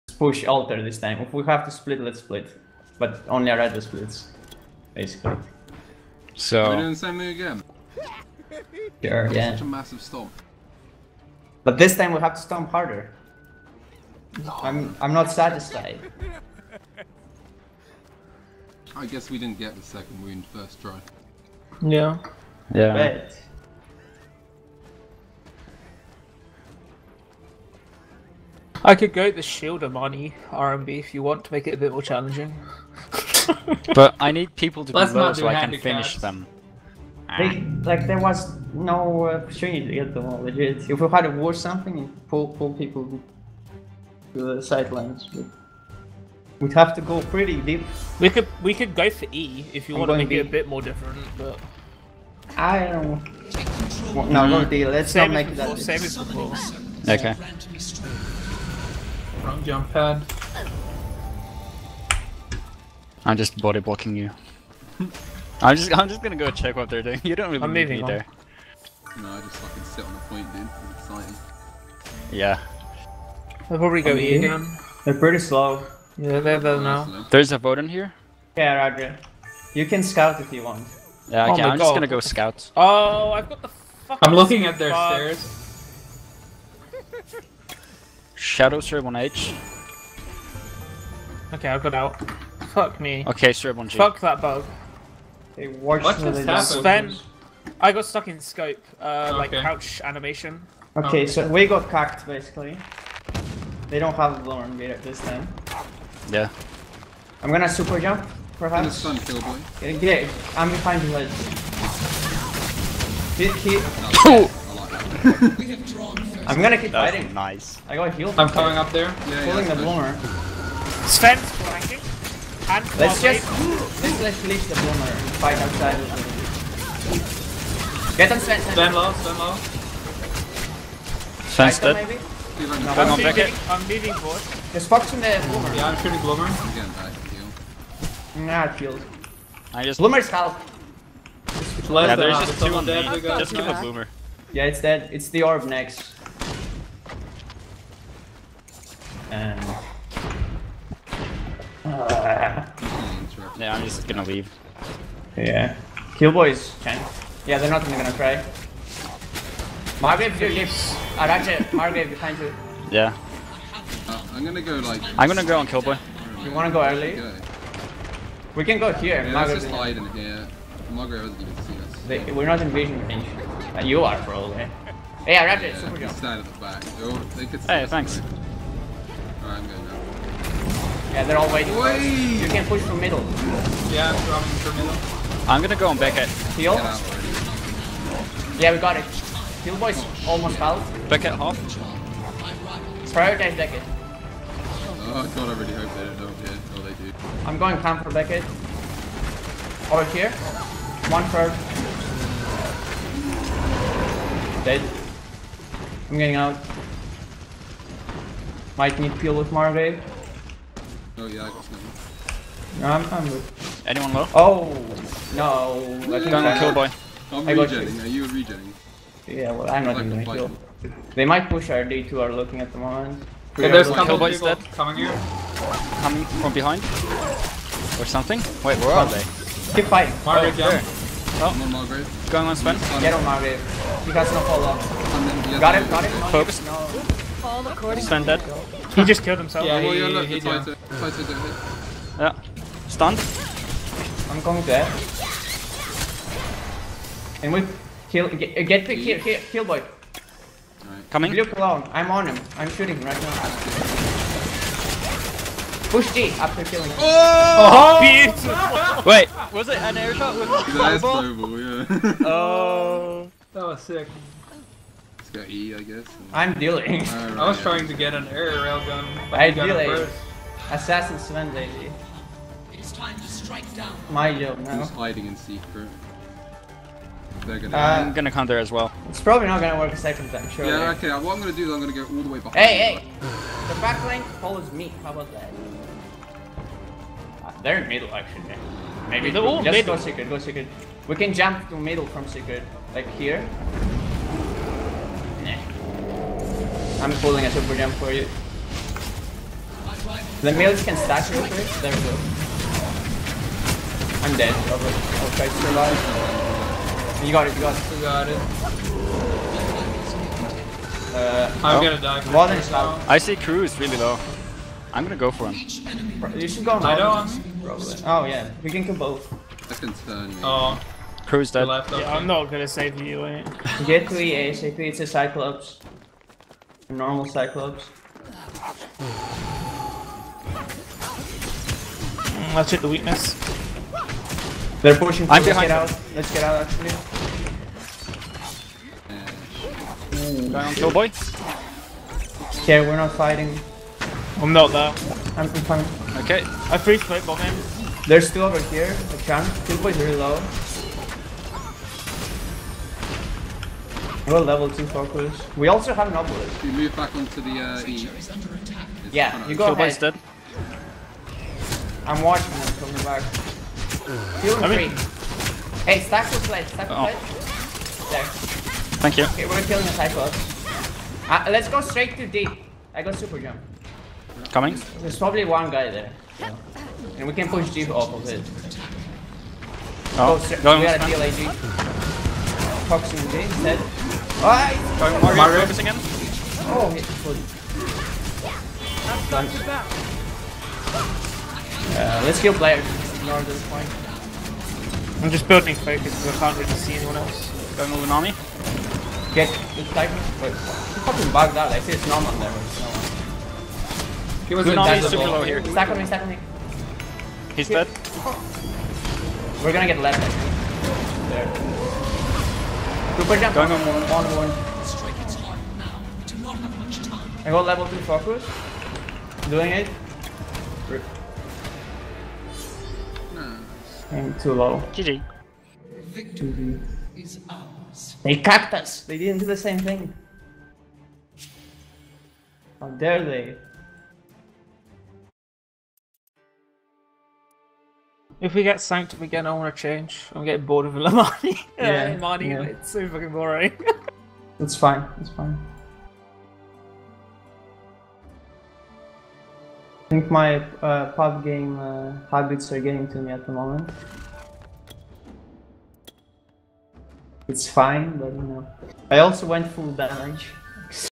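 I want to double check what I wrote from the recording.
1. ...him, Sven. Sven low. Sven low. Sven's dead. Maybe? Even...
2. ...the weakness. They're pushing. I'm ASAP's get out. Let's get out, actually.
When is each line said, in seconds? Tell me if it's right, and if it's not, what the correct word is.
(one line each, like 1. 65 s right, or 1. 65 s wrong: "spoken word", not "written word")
1. 128 s right
2. 332 s wrong: "Let", not "ASAP".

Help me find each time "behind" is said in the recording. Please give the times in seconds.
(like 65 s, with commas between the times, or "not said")
110 s, 162 s, 226 s, 282 s.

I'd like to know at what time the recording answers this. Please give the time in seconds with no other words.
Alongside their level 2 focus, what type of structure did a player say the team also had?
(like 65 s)
355 s.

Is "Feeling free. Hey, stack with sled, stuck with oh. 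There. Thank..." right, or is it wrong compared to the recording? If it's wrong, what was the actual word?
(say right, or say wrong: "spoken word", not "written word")
wrong: "stack", not "stuck".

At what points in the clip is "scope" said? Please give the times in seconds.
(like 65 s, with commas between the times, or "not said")
98 s.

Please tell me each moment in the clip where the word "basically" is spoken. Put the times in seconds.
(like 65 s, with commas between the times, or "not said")
4 s, 102 s.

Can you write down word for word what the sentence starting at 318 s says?
Oh yeah, we can do both.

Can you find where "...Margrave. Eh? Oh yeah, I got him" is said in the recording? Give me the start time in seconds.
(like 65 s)
209 s.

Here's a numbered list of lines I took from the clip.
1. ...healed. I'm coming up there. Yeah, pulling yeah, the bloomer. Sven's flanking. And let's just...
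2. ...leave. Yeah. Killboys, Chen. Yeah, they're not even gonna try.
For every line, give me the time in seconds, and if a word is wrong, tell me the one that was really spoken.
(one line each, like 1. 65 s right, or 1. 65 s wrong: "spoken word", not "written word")
1. 118 s right
2. 154 s right.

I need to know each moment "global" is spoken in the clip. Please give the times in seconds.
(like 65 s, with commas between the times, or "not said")
261 s.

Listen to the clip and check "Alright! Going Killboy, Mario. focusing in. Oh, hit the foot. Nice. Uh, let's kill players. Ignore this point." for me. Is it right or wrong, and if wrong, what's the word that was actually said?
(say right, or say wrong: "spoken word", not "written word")
wrong: "Mario", not "Killboy".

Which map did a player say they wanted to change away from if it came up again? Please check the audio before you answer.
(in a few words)
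Sanctum.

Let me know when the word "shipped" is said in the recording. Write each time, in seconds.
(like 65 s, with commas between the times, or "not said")
not said.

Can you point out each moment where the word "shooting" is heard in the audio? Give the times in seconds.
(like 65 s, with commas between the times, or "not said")
136 s, 252 s.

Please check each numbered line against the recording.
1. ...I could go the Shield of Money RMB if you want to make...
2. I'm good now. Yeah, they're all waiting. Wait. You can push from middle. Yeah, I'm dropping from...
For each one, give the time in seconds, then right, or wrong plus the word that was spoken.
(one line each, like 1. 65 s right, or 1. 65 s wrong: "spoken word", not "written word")
1. 28 s right
2. 179 s right.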